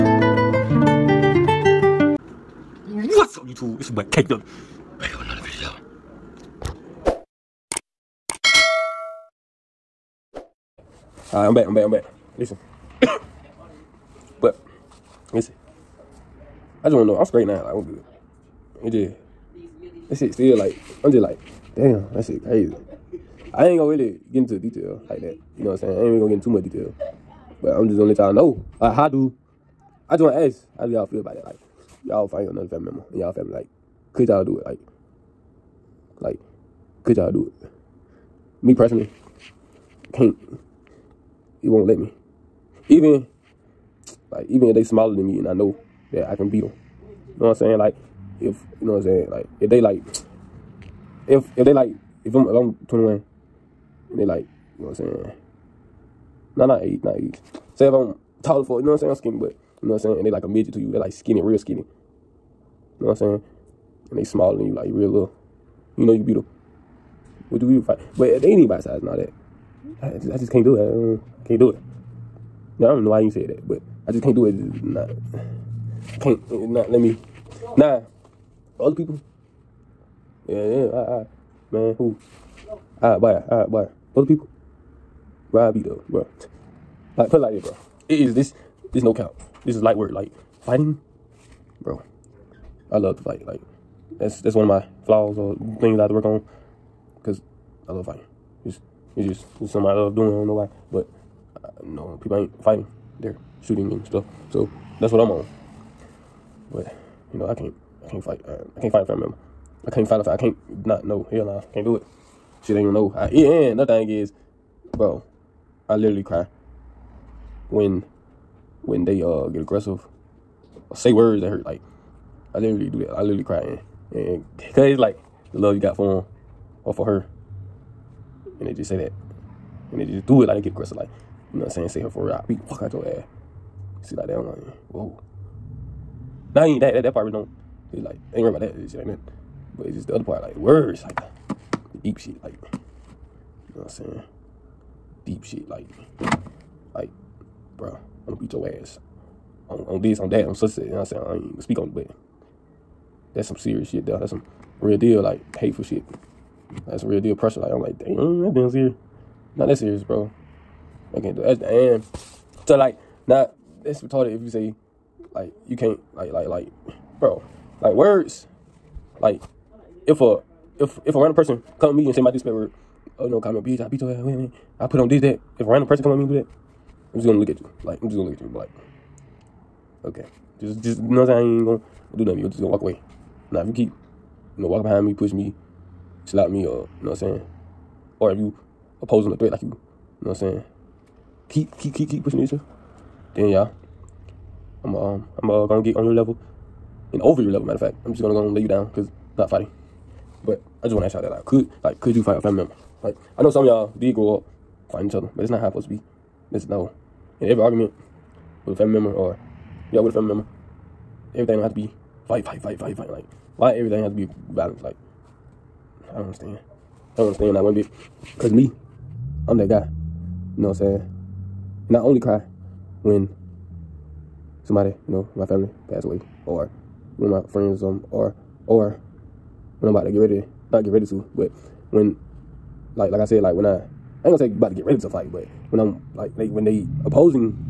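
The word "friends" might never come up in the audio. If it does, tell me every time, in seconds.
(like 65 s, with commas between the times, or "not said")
227 s.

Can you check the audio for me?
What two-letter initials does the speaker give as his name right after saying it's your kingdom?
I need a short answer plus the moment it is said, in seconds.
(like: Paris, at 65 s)
KW, at 4 s.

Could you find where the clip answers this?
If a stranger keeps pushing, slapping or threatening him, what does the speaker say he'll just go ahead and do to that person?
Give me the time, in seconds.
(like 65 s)
198 s.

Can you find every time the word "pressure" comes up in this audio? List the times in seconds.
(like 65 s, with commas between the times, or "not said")
157 s.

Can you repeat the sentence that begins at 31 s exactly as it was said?
Like, y'all find another family member in y'all family, like, could y'all do it?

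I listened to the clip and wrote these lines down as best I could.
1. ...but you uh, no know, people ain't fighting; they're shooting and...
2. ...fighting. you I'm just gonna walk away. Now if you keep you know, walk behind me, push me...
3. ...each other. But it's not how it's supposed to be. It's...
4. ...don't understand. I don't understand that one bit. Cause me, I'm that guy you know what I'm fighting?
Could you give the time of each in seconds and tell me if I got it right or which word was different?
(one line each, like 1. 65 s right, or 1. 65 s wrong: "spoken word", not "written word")
1. 100 s right
2. 182 s wrong: "nothing", not "fighting"
3. 205 s right
4. 216 s wrong: "saying", not "fighting".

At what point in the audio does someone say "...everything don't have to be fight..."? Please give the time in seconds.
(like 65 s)
211 s.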